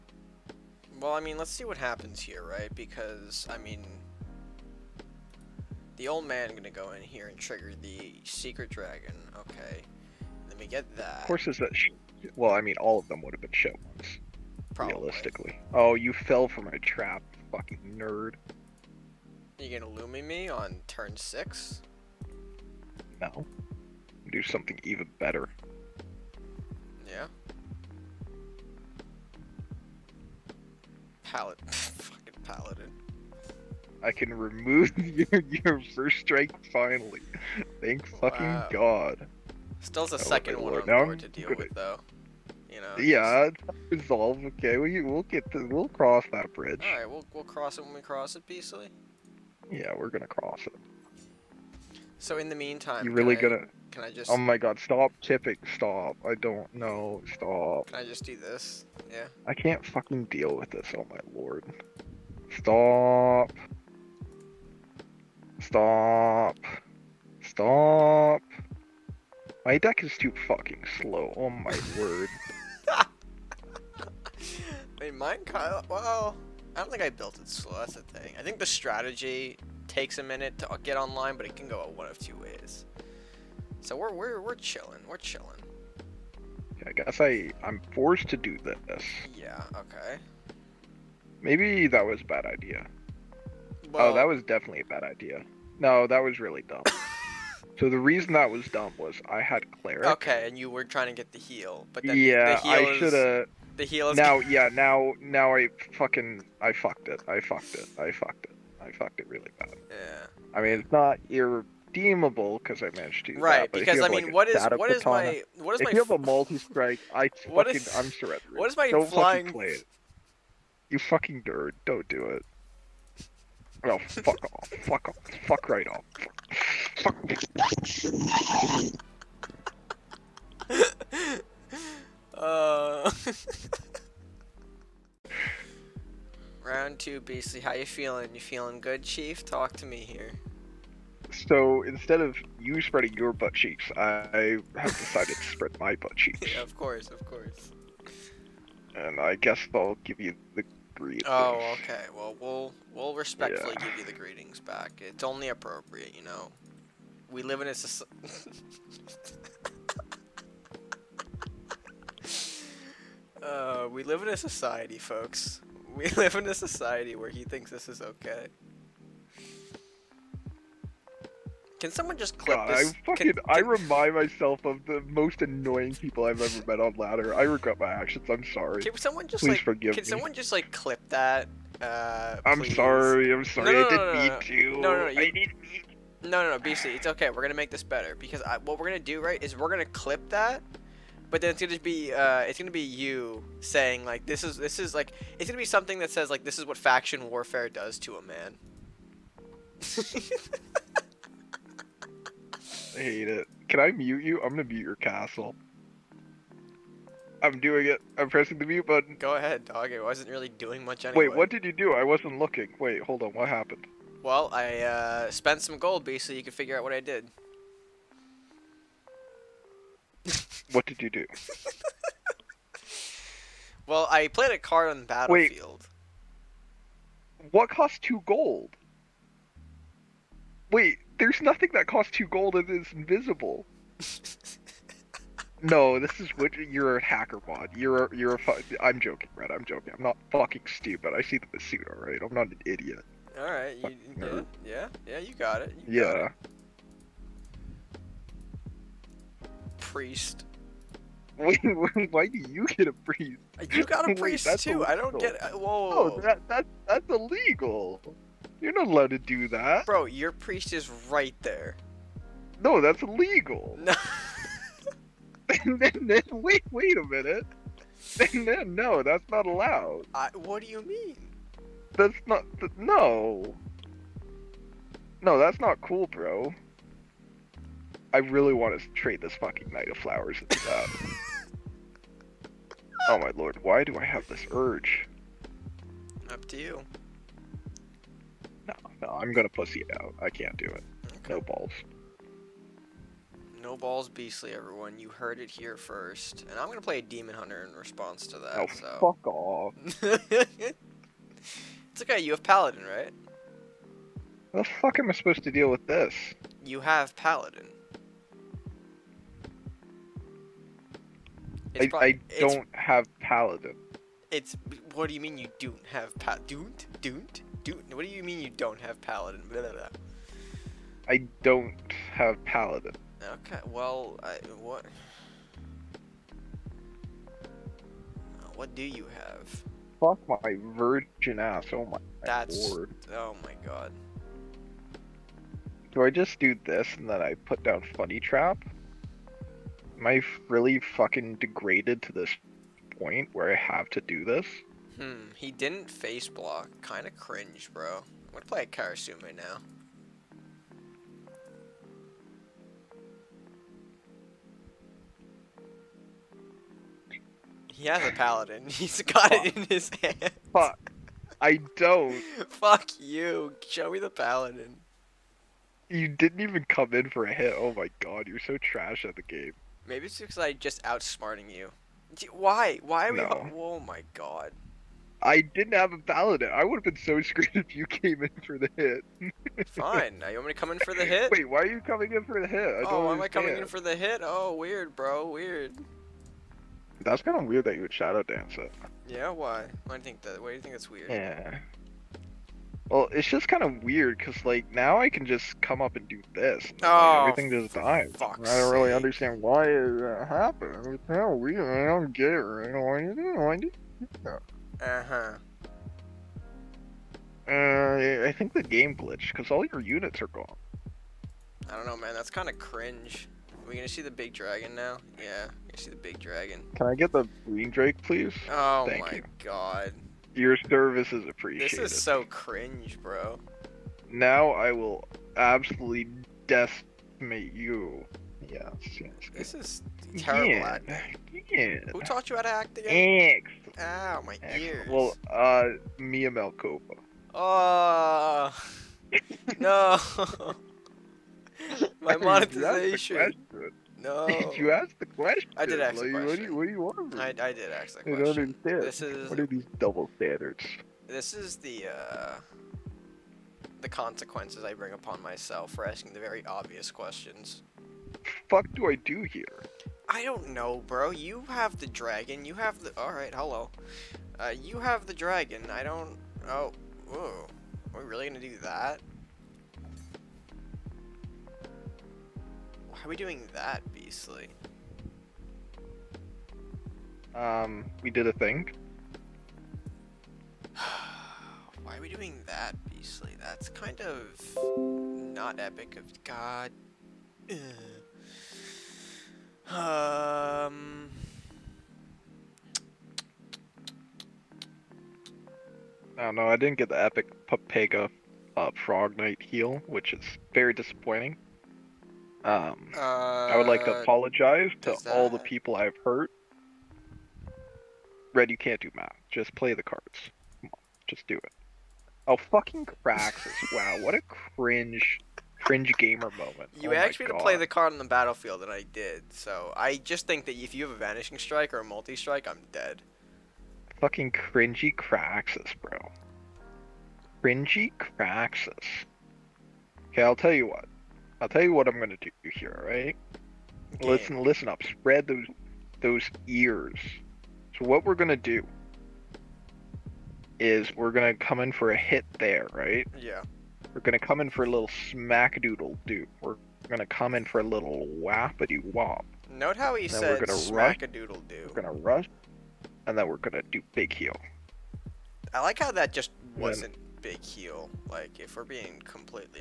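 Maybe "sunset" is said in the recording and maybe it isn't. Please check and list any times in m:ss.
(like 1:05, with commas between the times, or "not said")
not said.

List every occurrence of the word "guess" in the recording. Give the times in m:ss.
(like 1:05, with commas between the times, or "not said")
1:26, 2:29.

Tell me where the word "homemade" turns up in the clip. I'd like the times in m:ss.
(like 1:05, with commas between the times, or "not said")
not said.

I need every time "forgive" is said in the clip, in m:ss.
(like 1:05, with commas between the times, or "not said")
2:59.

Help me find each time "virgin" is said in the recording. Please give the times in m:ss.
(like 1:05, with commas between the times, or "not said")
5:30.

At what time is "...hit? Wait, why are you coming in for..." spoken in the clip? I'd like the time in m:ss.
6:21.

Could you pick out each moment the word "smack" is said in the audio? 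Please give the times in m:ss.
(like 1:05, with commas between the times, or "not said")
9:05, 9:10.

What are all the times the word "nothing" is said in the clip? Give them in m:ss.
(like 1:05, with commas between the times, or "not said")
3:51.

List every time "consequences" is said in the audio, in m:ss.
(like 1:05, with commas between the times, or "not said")
7:33.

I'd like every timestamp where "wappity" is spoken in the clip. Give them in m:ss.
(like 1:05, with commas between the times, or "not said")
9:08.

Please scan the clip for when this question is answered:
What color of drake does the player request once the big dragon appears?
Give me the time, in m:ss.
6:57.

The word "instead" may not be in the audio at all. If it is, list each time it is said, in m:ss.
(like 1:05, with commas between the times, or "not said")
2:21.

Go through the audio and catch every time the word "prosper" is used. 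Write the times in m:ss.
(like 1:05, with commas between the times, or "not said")
not said.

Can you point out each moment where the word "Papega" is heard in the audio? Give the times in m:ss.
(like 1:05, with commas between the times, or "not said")
8:17.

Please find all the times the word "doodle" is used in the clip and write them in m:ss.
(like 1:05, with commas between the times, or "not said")
9:05, 9:11.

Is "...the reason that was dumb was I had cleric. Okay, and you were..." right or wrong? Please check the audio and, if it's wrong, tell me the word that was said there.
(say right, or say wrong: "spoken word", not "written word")
right.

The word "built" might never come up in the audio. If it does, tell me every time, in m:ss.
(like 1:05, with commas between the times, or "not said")
1:17.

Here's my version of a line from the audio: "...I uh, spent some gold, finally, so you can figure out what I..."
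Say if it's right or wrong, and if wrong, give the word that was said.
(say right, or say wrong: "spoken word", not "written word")
wrong: "basically", not "finally".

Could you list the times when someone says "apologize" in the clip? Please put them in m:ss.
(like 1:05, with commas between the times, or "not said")
8:24.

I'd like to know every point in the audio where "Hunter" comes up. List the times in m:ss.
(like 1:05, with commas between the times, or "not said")
4:57.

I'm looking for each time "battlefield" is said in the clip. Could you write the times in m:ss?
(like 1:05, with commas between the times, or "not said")
3:45, 8:38.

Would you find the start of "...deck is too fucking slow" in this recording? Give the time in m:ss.
1:09.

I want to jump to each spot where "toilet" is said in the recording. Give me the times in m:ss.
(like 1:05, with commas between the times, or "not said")
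not said.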